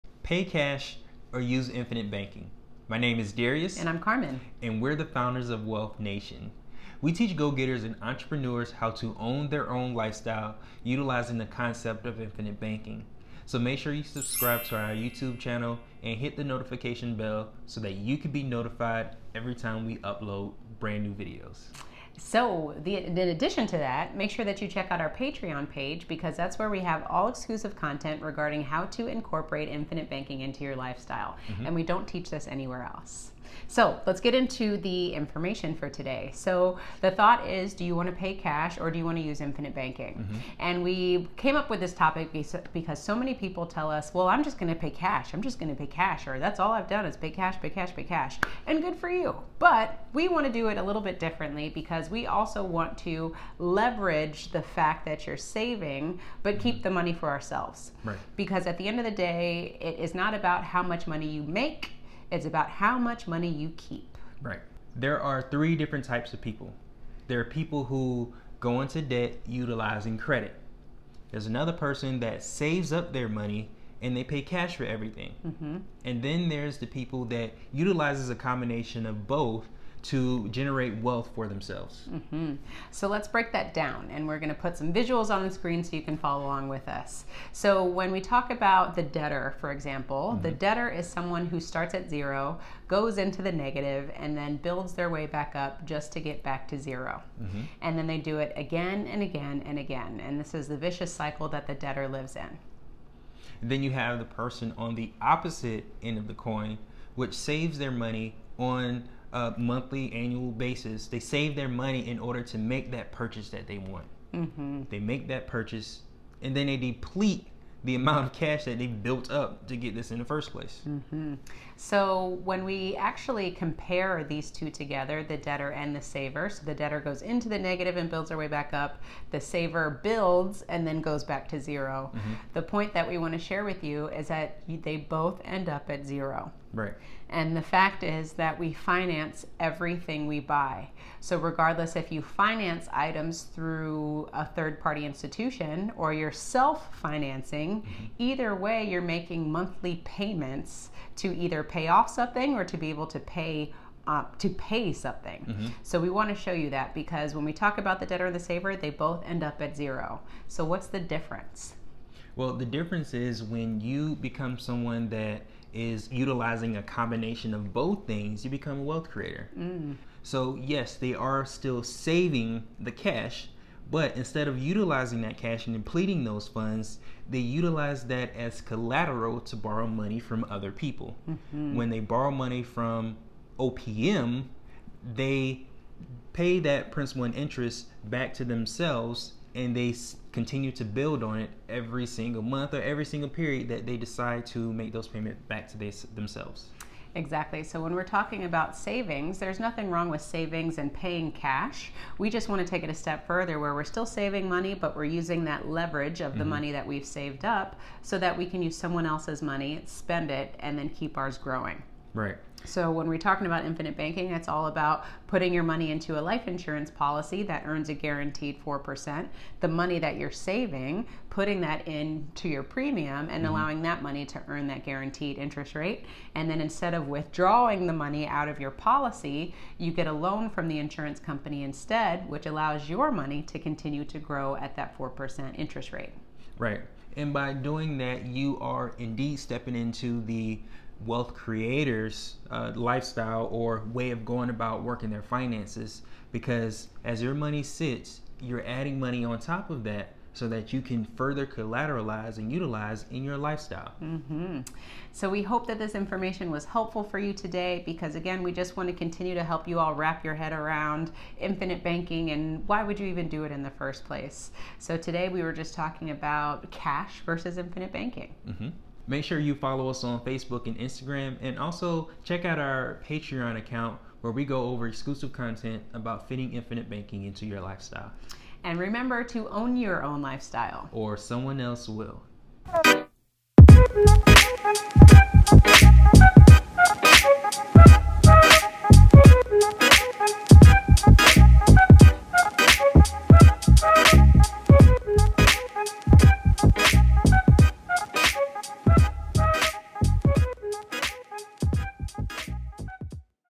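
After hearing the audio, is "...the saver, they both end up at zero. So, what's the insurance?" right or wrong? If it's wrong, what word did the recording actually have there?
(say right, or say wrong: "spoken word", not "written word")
wrong: "difference", not "insurance".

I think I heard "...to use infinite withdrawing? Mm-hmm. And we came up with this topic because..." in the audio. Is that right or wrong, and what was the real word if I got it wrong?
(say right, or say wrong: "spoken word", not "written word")
wrong: "banking", not "withdrawing".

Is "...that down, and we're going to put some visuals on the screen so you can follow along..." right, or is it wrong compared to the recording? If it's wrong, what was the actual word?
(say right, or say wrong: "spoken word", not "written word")
right.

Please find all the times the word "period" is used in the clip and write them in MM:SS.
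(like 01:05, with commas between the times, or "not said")
03:13.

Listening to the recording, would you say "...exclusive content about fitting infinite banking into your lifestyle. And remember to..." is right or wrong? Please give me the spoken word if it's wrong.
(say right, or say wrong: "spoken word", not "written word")
right.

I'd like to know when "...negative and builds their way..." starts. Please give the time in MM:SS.
02:07.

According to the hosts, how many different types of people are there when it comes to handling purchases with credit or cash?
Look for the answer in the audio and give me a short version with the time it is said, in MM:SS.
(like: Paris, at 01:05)
3, at 01:05.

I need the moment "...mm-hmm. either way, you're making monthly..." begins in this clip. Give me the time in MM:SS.
02:27.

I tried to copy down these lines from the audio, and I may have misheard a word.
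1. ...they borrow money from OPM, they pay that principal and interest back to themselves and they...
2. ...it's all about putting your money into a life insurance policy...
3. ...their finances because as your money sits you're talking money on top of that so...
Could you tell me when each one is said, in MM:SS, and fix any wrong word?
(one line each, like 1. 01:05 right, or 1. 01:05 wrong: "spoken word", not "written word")
1. 03:01 right
2. 03:34 right
3. 04:05 wrong: "adding", not "talking".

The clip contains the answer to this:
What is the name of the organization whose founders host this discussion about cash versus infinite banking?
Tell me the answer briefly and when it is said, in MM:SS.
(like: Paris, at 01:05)
Wealth Nation, at 00:05.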